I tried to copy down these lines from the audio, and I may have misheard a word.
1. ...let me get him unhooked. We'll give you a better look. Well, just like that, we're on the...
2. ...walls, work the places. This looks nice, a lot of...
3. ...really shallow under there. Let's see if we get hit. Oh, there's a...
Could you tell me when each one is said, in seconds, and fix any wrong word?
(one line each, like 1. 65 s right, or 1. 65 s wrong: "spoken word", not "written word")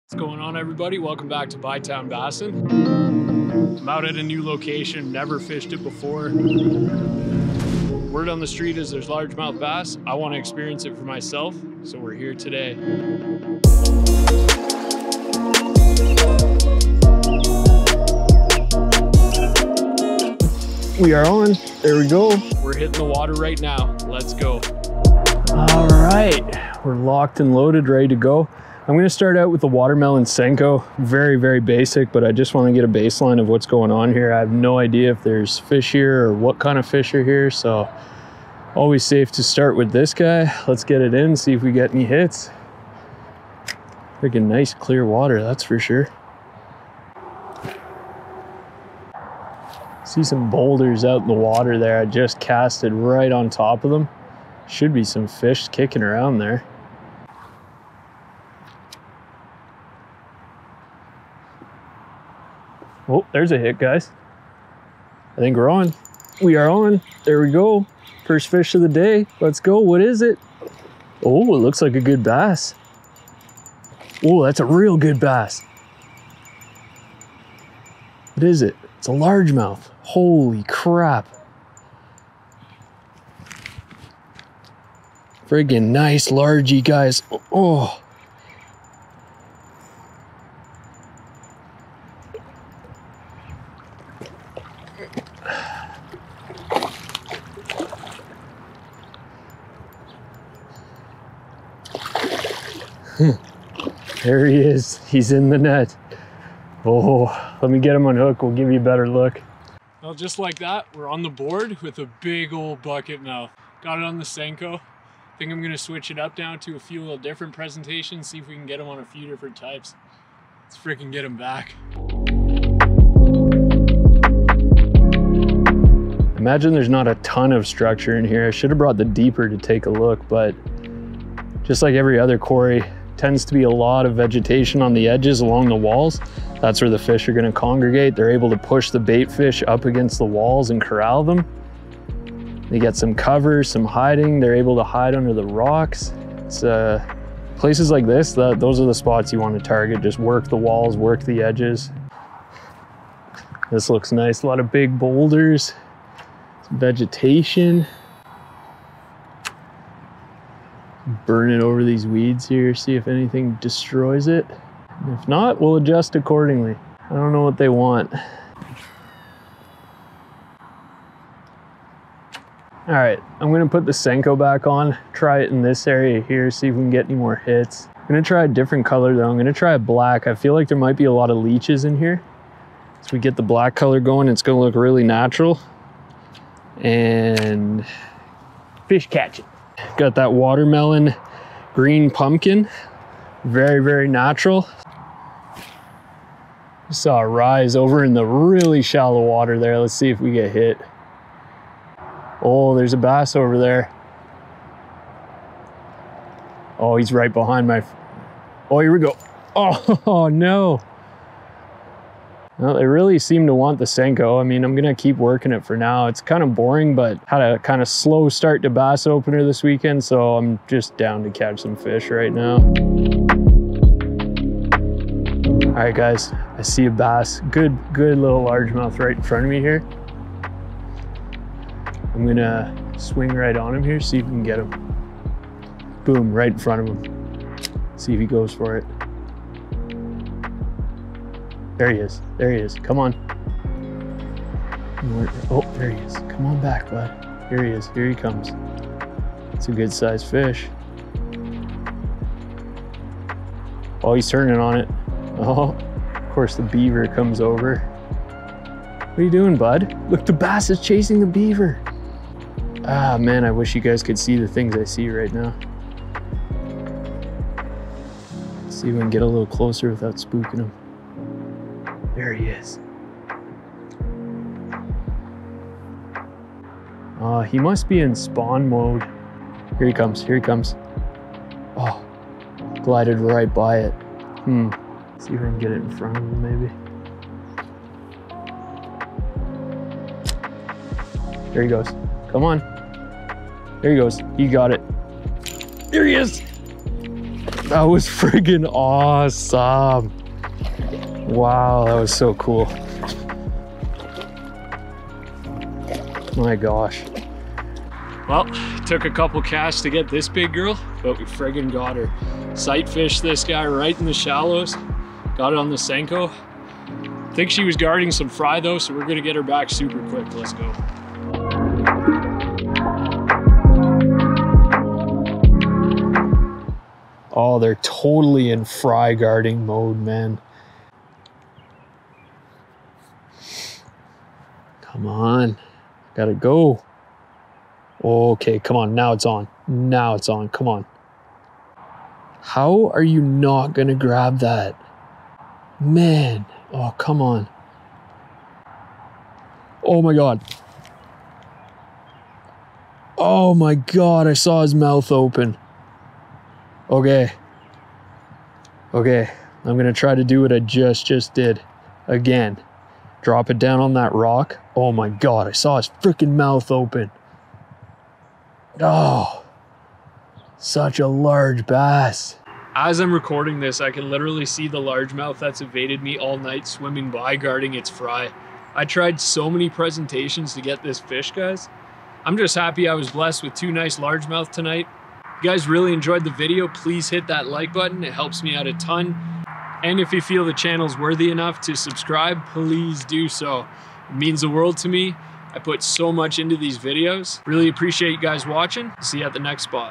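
1. 107 s right
2. 150 s wrong: "edges", not "places"
3. 198 s wrong: "water", not "under".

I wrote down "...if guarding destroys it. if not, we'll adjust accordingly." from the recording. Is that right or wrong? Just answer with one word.
wrong.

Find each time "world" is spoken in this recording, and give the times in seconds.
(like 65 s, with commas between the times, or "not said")
394 s.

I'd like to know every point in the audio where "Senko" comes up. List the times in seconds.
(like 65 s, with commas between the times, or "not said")
30 s, 114 s, 173 s, 213 s, 315 s.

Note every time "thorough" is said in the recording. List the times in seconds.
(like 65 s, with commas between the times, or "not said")
not said.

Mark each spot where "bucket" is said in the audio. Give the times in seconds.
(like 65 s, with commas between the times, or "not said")
112 s.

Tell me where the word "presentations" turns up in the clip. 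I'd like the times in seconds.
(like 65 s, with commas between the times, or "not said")
117 s, 379 s.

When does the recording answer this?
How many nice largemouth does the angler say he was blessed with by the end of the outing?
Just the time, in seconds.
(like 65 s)
383 s.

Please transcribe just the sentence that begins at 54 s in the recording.
Should be some fish kicking around there.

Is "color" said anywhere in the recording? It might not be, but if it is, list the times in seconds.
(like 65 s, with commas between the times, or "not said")
178 s, 183 s.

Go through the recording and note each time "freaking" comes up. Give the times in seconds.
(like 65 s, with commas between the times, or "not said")
44 s, 120 s, 366 s.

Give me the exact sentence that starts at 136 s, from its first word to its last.
That's where the fish are gonna congregate.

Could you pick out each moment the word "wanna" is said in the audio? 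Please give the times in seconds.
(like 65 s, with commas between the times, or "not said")
32 s, 149 s.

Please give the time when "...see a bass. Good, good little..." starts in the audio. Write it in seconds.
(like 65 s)
226 s.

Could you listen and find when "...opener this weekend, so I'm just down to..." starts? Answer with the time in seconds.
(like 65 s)
219 s.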